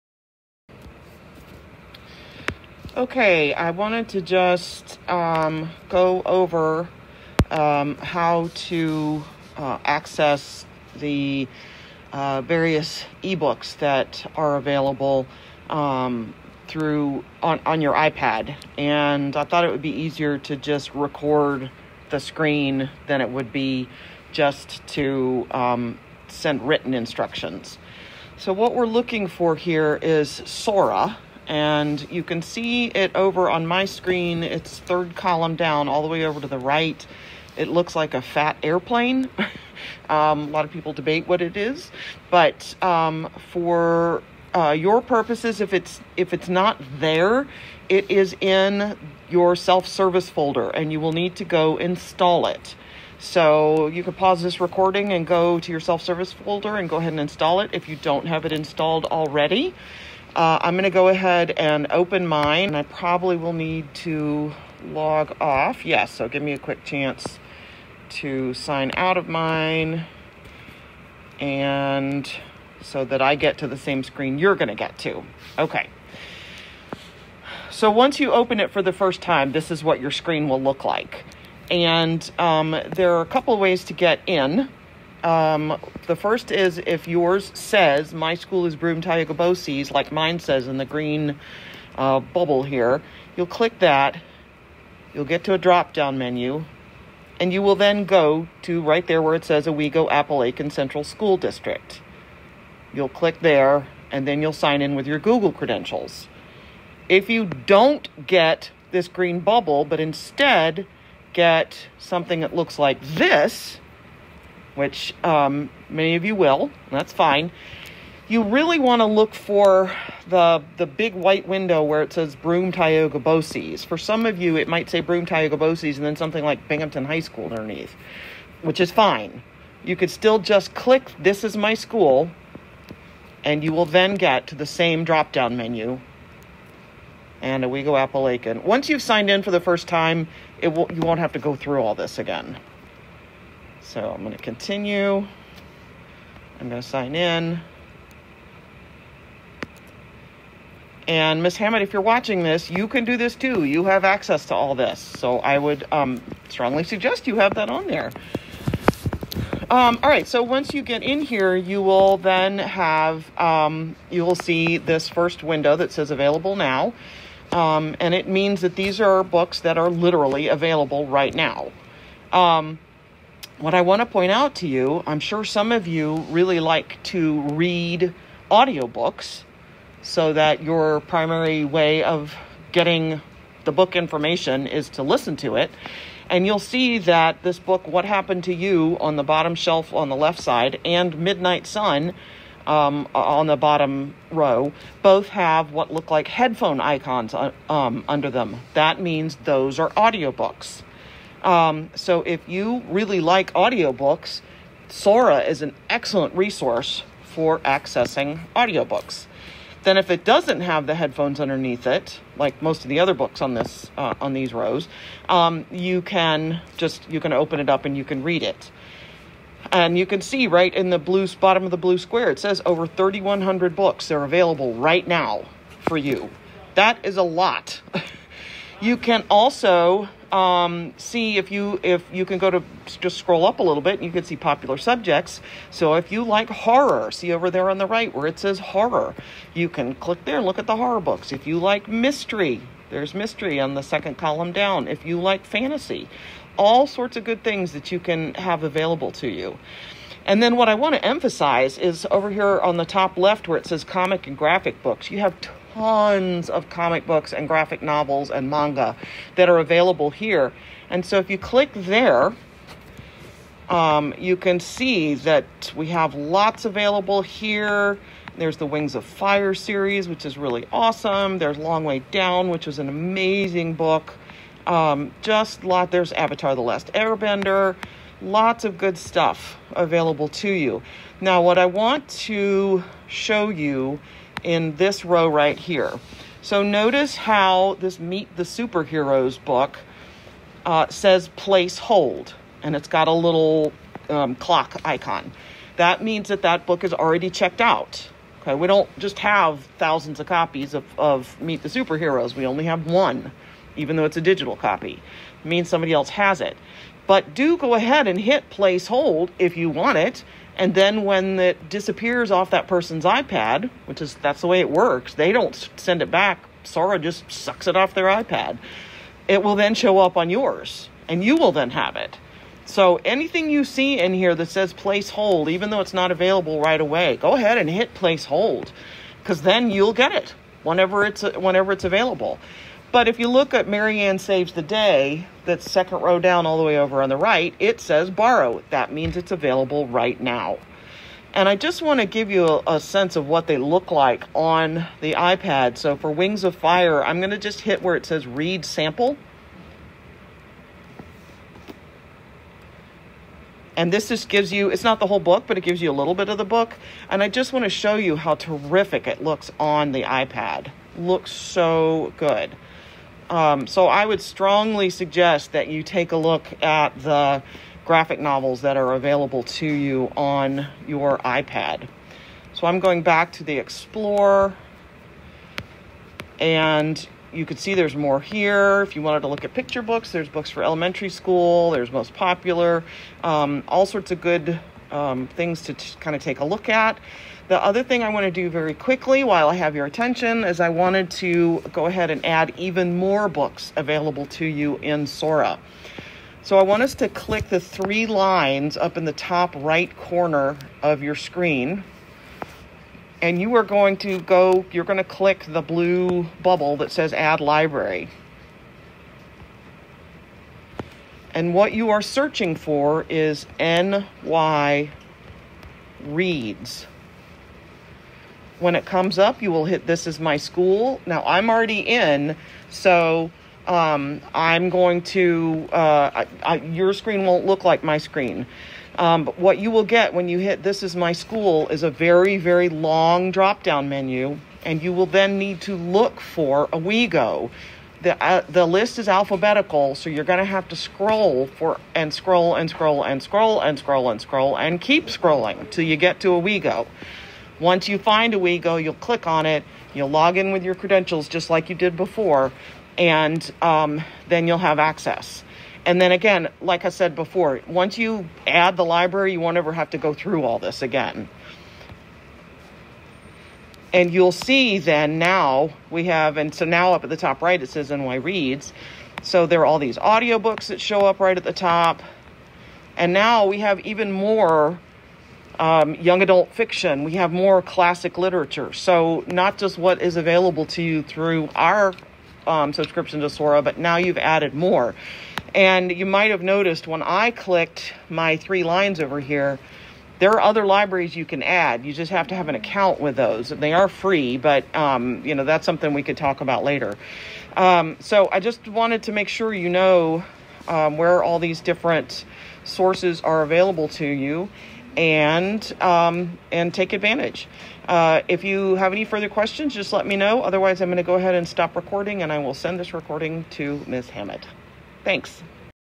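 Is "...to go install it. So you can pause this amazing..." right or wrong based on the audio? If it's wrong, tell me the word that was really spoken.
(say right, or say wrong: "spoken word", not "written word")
wrong: "recording", not "amazing".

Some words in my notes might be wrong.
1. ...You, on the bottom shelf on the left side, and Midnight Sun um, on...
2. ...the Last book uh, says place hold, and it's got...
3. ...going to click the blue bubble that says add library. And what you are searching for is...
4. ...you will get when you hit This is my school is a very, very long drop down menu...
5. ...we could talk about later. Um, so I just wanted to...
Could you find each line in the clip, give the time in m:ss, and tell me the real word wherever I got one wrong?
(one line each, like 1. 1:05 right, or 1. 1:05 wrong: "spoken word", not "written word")
1. 3:08 right
2. 4:48 wrong: "Superheroes", not "Last"
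3. 6:44 right
4. 7:09 right
5. 8:15 right.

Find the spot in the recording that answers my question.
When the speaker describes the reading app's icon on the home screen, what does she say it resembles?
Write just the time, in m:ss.
0:38.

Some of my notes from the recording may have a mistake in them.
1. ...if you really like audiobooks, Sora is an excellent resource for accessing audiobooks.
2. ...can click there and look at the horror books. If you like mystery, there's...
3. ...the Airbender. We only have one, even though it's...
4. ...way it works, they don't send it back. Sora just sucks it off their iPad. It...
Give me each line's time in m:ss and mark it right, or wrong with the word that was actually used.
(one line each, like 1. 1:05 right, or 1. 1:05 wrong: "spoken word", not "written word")
1. 3:22 right
2. 3:59 right
3. 5:01 wrong: "Superheroes", not "Airbender"
4. 5:14 right.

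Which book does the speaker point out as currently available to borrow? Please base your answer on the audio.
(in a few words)
Mary Anne Saves the Day.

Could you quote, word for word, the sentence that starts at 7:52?
And now we have even more um, young adult fiction.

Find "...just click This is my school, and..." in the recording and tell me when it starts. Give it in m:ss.
2:10.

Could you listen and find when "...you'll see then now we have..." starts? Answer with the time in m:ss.
7:44.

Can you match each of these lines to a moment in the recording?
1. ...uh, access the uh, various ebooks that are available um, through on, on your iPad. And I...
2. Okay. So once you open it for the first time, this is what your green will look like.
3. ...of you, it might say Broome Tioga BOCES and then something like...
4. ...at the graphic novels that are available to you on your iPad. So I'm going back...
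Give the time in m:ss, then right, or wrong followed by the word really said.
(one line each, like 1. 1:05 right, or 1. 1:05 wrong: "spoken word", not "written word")
1. 0:09 right
2. 1:15 wrong: "screen", not "green"
3. 2:04 right
4. 6:06 right.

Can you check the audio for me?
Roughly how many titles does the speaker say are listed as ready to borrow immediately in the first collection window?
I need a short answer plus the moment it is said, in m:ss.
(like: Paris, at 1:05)
Over 3,100, at 3:42.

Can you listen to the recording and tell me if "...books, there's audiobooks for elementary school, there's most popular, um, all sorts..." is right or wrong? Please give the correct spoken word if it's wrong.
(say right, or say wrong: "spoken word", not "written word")
wrong: "books", not "audiobooks".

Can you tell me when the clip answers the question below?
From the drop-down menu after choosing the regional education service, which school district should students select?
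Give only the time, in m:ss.
1:39.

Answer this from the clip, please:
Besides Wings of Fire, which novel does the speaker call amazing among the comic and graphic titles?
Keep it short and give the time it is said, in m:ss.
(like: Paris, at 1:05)
Long Way Down, at 4:31.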